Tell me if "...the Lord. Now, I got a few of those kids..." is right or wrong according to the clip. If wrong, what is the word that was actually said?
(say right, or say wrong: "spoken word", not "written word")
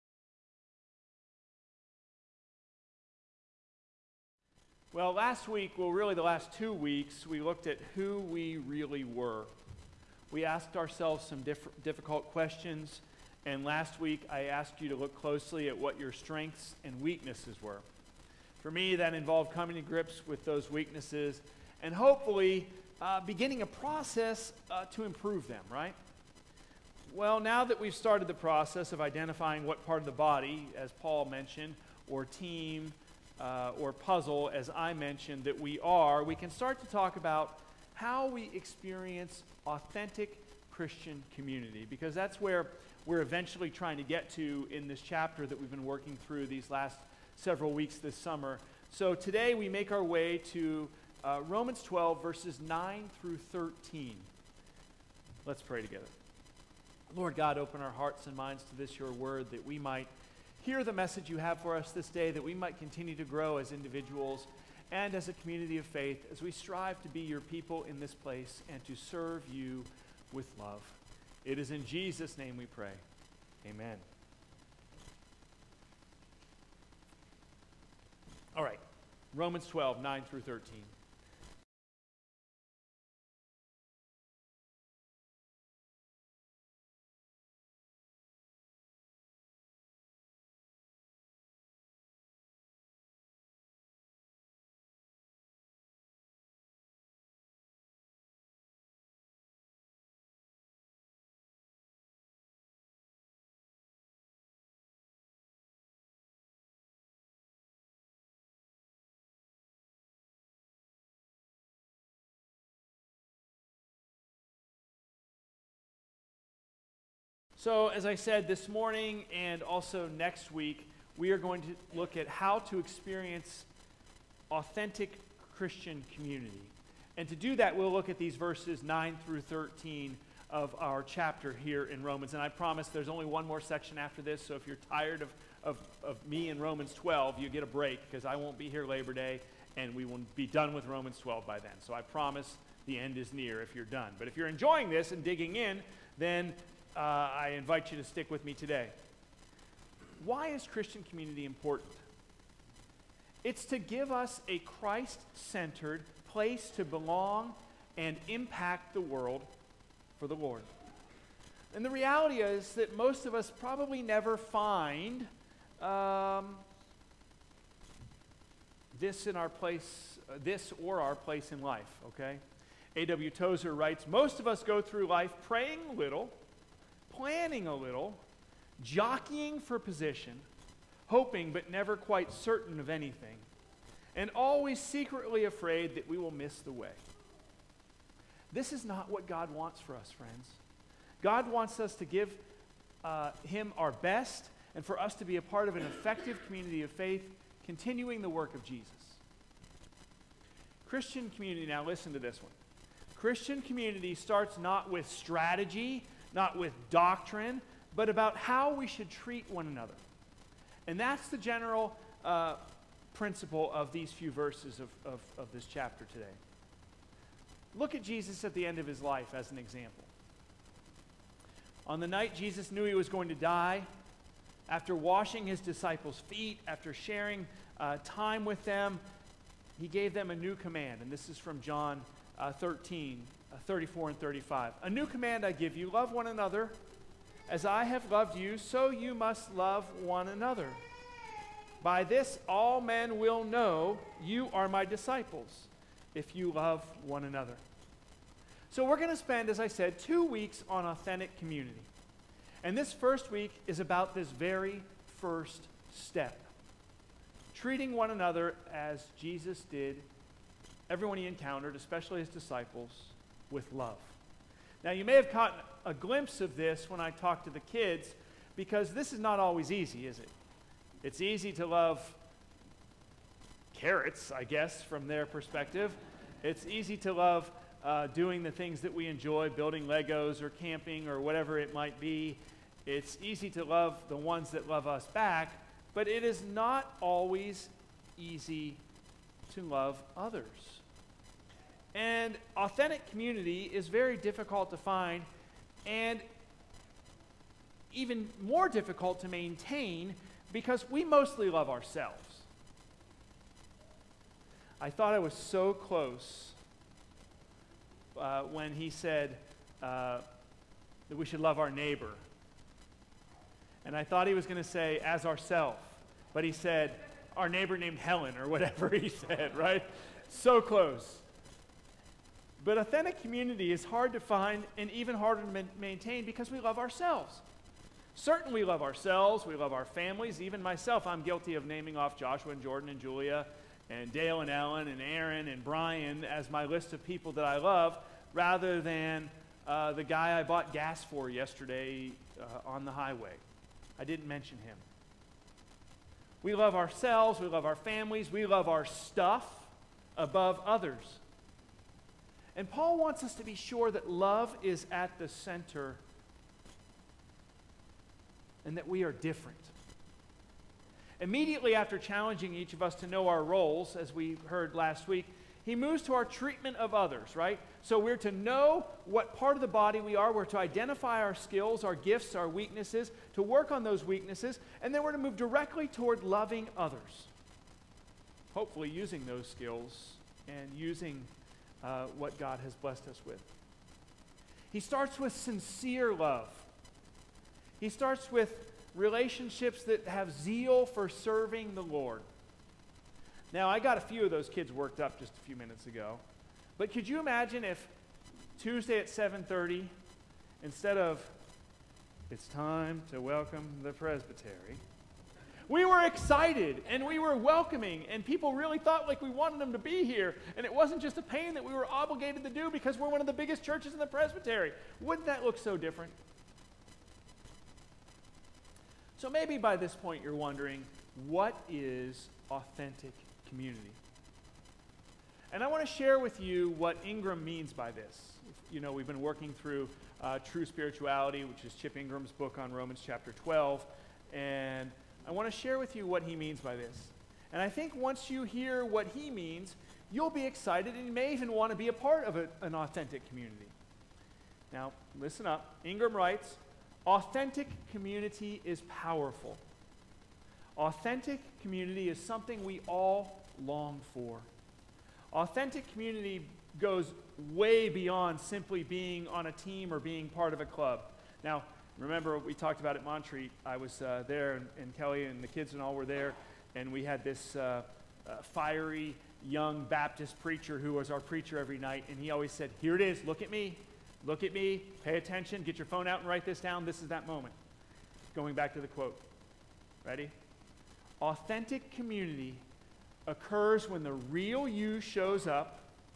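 right.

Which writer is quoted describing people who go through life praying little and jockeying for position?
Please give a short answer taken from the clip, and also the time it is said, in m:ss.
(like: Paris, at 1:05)
A.W. Tozer, at 2:52.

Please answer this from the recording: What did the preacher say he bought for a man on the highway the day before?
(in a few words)
Gas.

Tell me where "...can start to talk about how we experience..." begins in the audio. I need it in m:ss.
0:36.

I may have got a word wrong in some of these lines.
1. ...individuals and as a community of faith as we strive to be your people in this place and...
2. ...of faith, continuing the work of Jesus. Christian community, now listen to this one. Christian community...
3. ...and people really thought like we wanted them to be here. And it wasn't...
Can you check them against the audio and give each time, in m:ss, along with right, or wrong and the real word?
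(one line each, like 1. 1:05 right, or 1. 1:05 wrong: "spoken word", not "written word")
1. 1:03 right
2. 3:16 right
3. 6:48 right.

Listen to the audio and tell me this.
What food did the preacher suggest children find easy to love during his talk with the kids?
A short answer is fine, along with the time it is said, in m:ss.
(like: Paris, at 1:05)
Carrots, at 4:33.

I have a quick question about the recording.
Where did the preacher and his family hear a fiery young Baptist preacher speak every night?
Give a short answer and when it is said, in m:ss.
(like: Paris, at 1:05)
Montreat, at 7:43.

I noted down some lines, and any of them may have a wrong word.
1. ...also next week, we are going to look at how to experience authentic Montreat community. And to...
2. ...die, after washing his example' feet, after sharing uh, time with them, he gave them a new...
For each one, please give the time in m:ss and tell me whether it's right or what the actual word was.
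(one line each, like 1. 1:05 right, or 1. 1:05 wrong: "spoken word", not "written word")
1. 1:59 wrong: "Christian", not "Montreat"
2. 3:43 wrong: "disciples", not "example".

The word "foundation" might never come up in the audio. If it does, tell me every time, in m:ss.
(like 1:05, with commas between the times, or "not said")
not said.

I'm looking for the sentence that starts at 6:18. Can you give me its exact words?
Hopefully, using those skills and using uh, what God has blessed us with.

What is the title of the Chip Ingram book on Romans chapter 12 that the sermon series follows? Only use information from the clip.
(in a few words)
True Spirituality.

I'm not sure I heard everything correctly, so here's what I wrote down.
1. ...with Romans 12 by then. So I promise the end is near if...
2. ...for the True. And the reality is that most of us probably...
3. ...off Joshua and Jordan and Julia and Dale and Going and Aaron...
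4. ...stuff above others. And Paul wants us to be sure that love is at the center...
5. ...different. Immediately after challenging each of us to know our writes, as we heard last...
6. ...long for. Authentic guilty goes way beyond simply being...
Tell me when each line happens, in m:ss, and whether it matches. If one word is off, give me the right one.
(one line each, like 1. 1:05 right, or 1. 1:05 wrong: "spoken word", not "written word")
1. 2:20 right
2. 2:40 wrong: "Lord", not "True"
3. 5:31 wrong: "Ellen", not "Going"
4. 5:48 right
5. 5:59 wrong: "roles", not "writes"
6. 7:33 wrong: "community", not "guilty".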